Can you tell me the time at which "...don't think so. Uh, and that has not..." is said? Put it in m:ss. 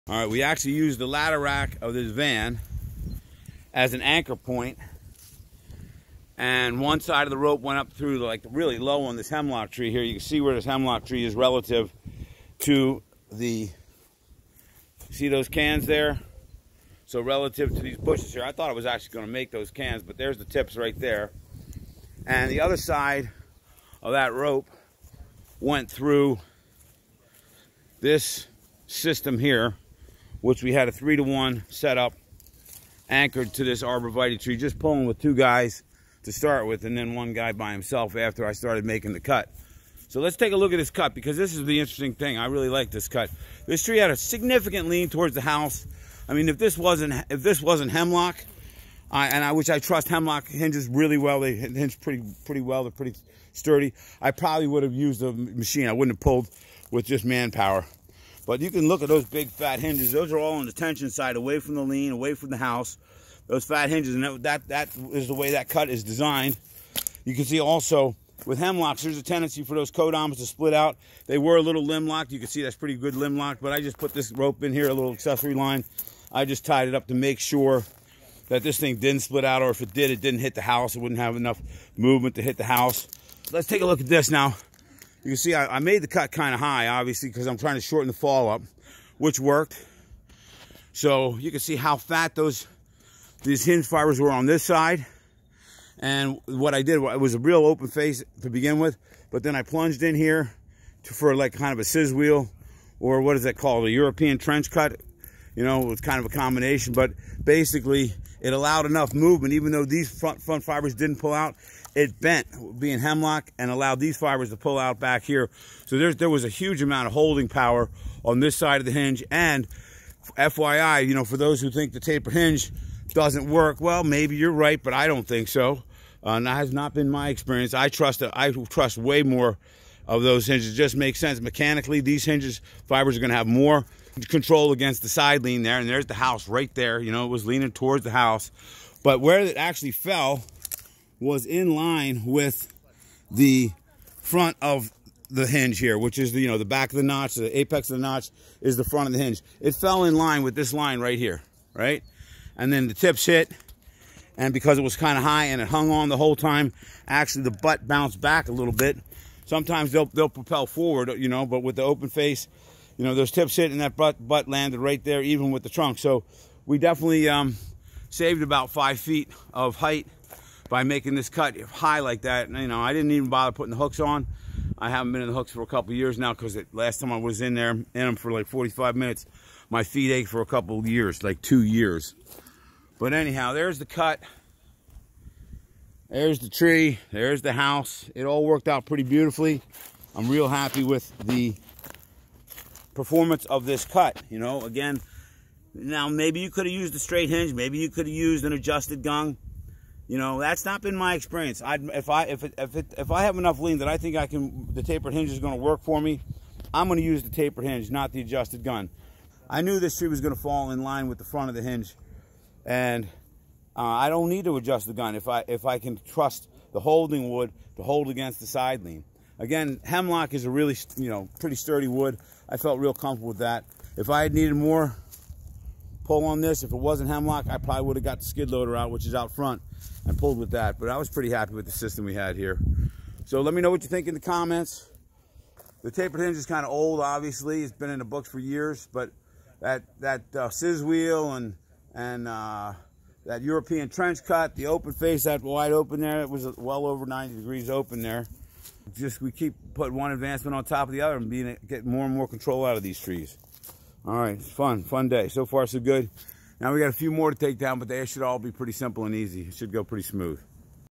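2:05.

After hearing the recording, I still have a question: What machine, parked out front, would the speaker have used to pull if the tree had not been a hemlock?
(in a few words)
skid loader.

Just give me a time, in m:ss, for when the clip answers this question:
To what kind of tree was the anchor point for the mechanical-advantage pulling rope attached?
0:33.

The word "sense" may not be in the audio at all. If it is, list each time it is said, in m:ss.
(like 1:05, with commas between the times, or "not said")
2:11.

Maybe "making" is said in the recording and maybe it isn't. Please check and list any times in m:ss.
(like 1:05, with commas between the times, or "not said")
0:38, 2:50.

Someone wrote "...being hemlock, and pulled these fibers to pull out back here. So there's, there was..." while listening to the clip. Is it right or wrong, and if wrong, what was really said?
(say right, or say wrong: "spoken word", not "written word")
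wrong: "allowed", not "pulled".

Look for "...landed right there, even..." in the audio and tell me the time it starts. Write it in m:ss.
2:44.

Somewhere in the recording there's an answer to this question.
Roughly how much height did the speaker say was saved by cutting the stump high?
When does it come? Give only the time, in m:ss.
2:48.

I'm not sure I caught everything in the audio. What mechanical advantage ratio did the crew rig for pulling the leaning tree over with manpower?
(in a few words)
3 to 1.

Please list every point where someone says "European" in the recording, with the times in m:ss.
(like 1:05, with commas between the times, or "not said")
1:43, 4:03.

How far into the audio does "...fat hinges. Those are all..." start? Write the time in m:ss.
0:59.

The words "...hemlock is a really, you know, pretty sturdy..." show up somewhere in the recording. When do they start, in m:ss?
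3:39.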